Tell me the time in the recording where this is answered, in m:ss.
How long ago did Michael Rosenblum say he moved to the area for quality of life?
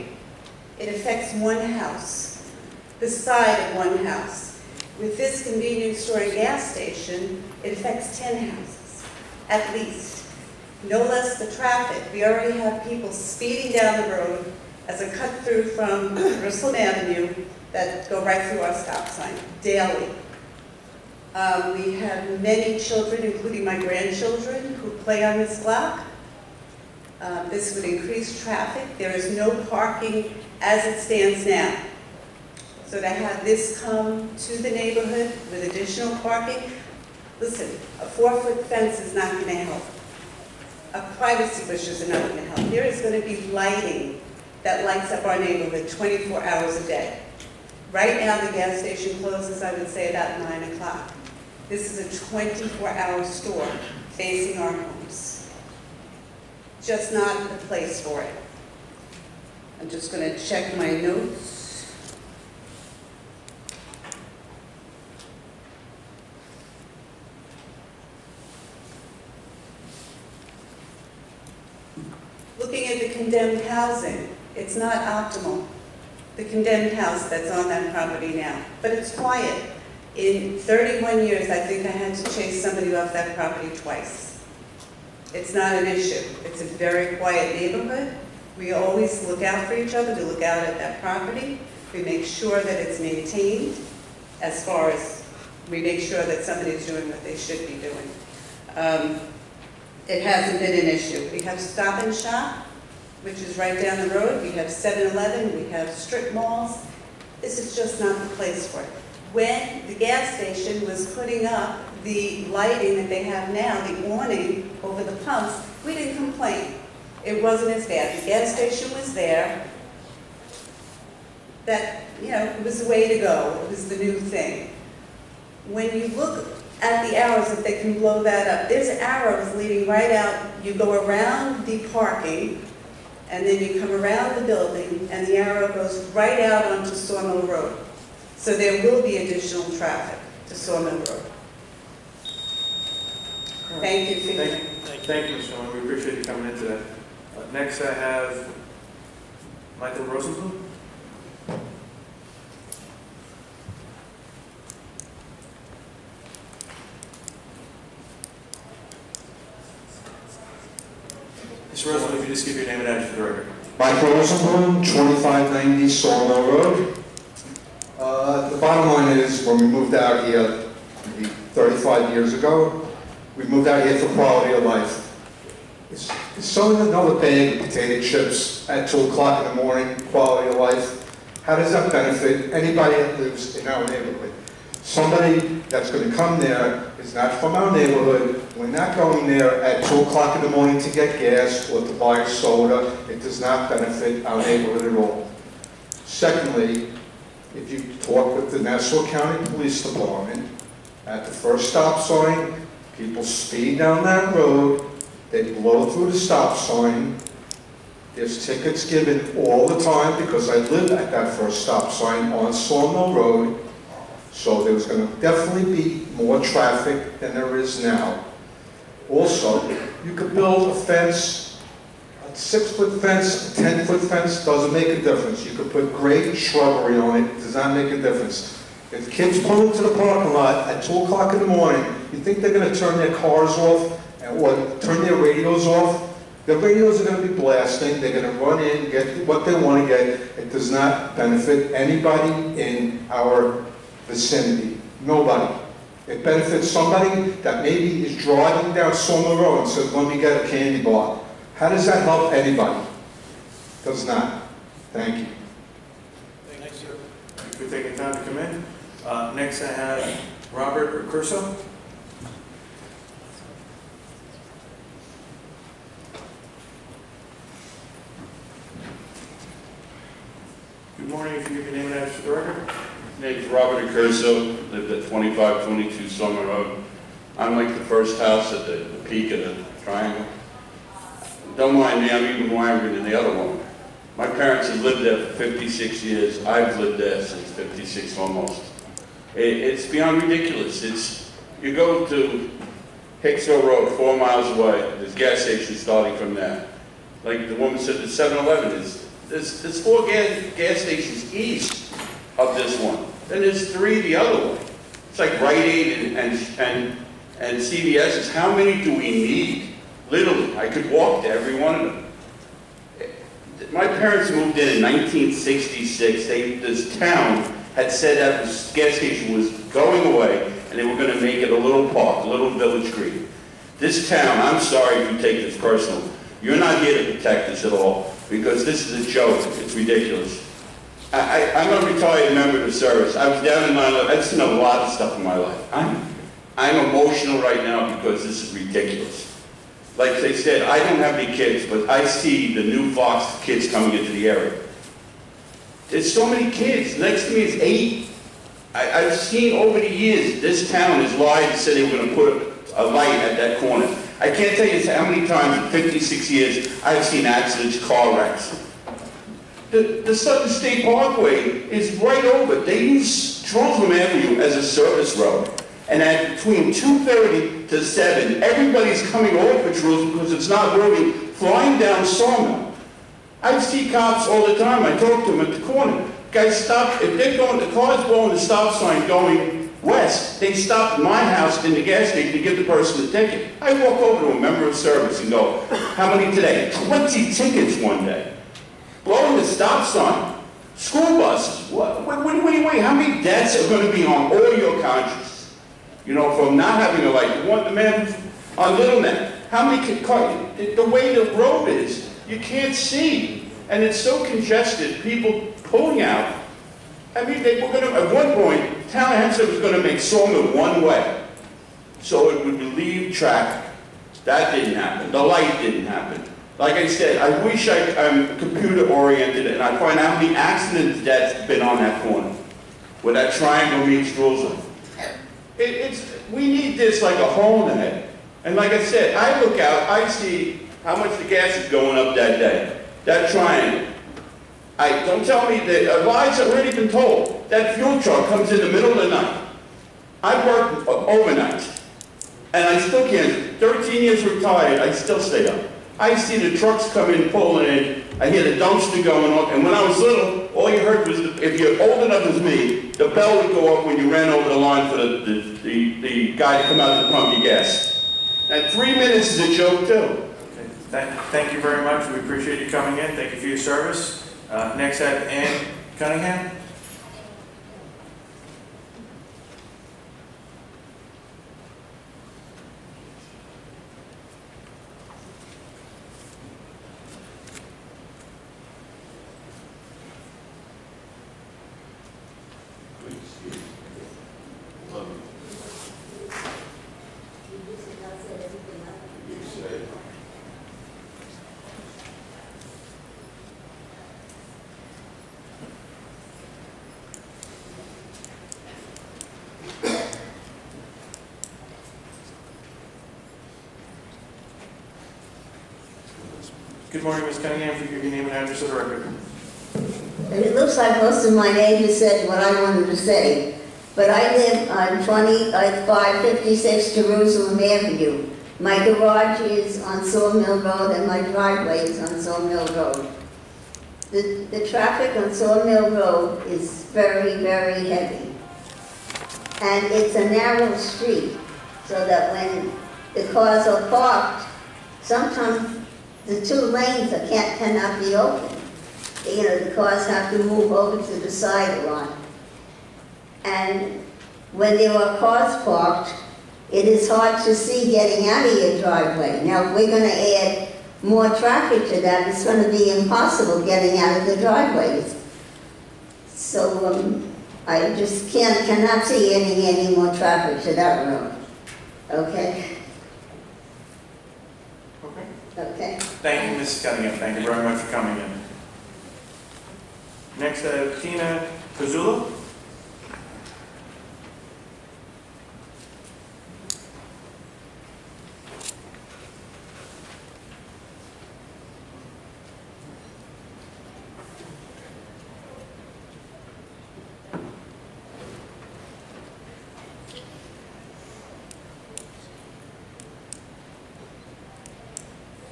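2:51.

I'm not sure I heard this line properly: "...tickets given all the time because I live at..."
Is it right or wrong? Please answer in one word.
right.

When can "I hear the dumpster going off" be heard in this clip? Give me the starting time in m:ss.
7:28.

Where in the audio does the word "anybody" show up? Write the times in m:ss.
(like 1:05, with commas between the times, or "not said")
3:02, 4:01, 4:12.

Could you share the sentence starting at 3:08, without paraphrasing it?
We're not going there at 2 o'clock in the morning to get gas or to buy soda.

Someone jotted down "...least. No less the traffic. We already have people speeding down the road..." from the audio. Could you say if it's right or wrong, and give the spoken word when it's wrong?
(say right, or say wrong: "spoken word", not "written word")
right.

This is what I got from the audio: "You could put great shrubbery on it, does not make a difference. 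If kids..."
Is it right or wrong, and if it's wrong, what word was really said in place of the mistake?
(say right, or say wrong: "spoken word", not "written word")
right.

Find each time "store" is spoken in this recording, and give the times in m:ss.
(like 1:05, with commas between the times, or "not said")
0:05, 0:53.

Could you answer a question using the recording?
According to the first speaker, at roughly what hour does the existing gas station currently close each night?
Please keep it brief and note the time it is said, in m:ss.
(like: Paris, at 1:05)
9 o'clock, at 0:50.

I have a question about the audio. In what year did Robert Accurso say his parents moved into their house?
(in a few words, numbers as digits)
1966.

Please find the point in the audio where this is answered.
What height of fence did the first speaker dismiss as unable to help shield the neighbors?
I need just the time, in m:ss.
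0:38.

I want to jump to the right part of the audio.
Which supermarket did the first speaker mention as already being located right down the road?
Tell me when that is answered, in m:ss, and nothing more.
1:41.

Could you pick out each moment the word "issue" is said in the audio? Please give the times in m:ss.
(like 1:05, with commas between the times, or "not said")
1:25, 1:40.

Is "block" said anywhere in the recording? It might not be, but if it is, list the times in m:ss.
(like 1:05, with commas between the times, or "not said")
0:25.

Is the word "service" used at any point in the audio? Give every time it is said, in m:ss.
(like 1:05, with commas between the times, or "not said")
5:32, 6:04, 6:24, 7:43.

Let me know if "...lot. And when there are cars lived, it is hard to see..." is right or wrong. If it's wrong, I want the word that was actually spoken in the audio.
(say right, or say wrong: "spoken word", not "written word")
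wrong: "parked", not "lived".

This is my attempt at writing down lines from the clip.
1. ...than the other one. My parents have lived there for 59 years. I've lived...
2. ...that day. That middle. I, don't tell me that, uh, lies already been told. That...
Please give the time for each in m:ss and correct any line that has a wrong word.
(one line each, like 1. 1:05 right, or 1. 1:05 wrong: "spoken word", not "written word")
1. 4:42 wrong: "56", not "59"
2. 7:12 wrong: "triangle", not "middle".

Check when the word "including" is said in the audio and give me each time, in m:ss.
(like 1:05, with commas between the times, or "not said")
0:23.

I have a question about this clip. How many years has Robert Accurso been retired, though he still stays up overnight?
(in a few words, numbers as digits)
13.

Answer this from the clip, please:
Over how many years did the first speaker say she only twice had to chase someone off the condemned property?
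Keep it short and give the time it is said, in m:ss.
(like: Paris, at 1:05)
31, at 1:20.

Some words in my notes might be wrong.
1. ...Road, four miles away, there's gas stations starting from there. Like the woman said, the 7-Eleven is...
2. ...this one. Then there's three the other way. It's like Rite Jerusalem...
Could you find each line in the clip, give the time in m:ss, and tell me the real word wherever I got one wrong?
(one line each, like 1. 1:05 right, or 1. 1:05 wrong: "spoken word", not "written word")
1. 4:53 right
2. 5:02 wrong: "Aid", not "Jerusalem".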